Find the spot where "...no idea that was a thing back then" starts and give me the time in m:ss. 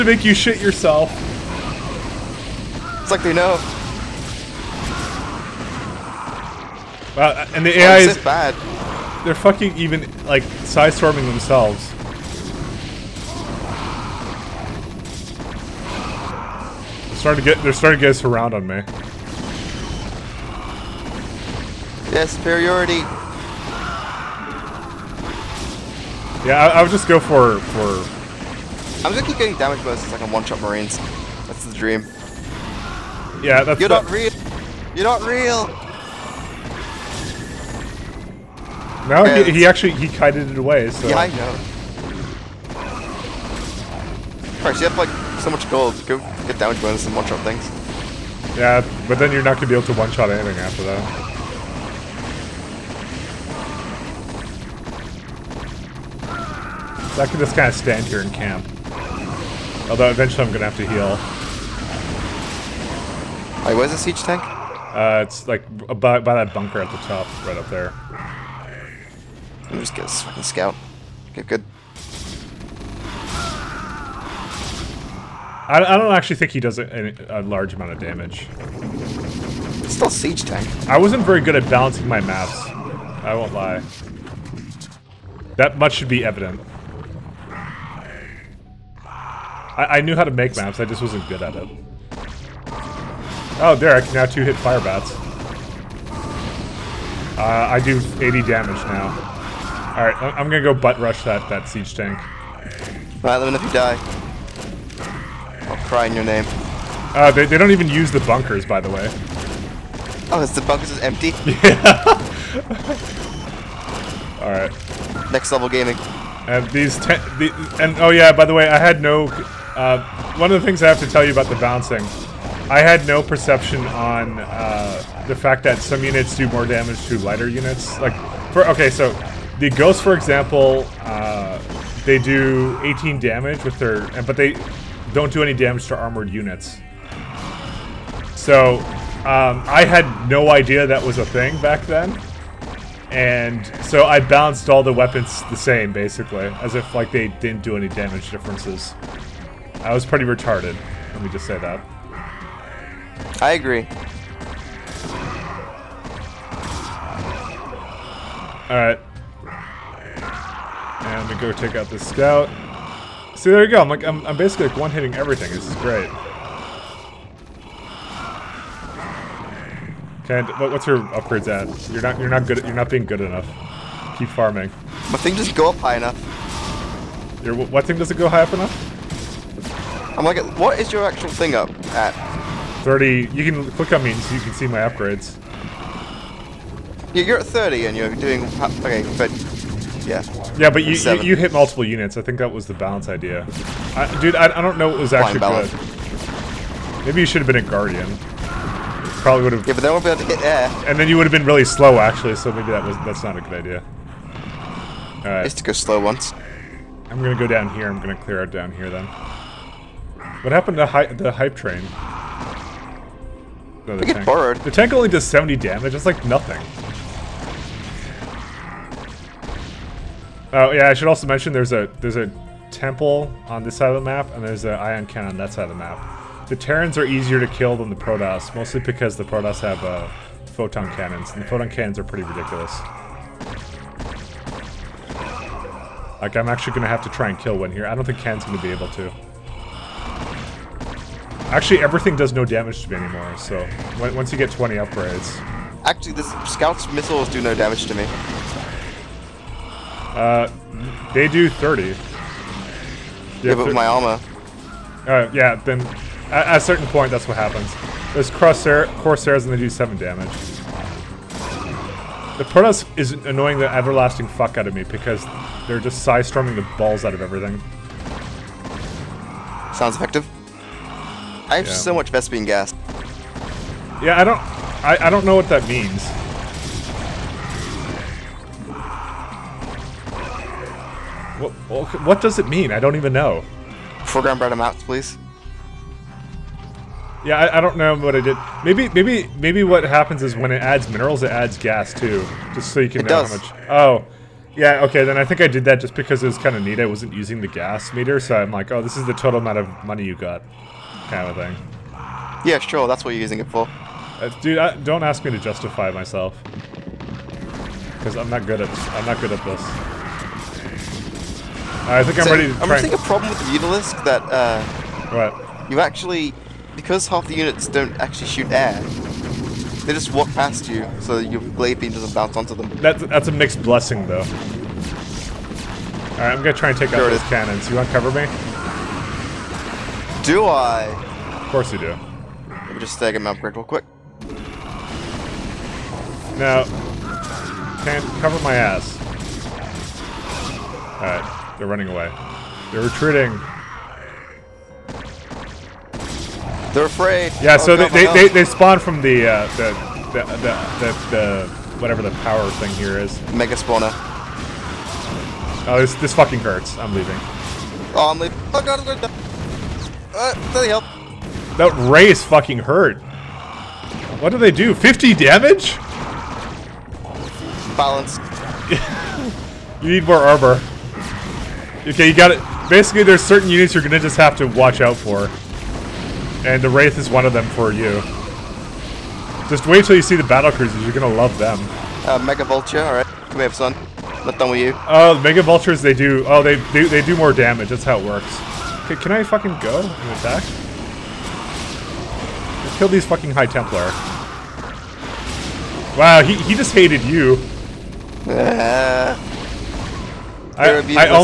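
2:20.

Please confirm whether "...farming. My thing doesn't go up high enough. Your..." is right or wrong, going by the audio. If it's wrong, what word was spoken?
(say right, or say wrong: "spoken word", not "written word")
right.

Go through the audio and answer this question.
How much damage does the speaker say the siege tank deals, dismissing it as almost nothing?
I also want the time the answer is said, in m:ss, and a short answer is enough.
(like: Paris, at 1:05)
70, at 3:35.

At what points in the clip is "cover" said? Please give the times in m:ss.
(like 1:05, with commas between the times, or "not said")
5:27, 5:38.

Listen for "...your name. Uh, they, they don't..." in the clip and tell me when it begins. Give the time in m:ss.
1:46.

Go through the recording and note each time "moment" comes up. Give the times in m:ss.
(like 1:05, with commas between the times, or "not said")
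not said.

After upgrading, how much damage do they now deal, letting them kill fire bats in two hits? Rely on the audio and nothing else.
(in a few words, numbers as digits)
80.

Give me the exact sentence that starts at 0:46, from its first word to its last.
Go get damage bonus and one-shot things.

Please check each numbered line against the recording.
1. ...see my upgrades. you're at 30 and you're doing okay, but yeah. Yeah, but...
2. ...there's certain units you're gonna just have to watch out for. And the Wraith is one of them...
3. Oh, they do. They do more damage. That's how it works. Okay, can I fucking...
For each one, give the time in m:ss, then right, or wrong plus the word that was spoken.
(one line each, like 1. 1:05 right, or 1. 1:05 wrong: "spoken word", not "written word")
1. 3:04 right
2. 6:13 right
3. 6:26 right.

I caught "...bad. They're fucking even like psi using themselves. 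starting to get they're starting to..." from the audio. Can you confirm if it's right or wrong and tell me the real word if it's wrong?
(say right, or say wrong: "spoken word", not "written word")
wrong: "storming", not "using".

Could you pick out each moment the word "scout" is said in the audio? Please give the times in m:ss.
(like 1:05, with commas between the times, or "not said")
1:10, 2:41, 4:06.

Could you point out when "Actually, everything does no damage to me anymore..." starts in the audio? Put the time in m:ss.
4:01.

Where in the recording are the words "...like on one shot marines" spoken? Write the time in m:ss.
0:30.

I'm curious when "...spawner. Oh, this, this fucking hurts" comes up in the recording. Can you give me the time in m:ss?
5:53.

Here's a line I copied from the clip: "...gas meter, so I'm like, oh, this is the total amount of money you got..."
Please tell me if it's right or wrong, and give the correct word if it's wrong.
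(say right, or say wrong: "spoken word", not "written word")
right.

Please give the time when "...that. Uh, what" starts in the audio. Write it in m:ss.
5:14.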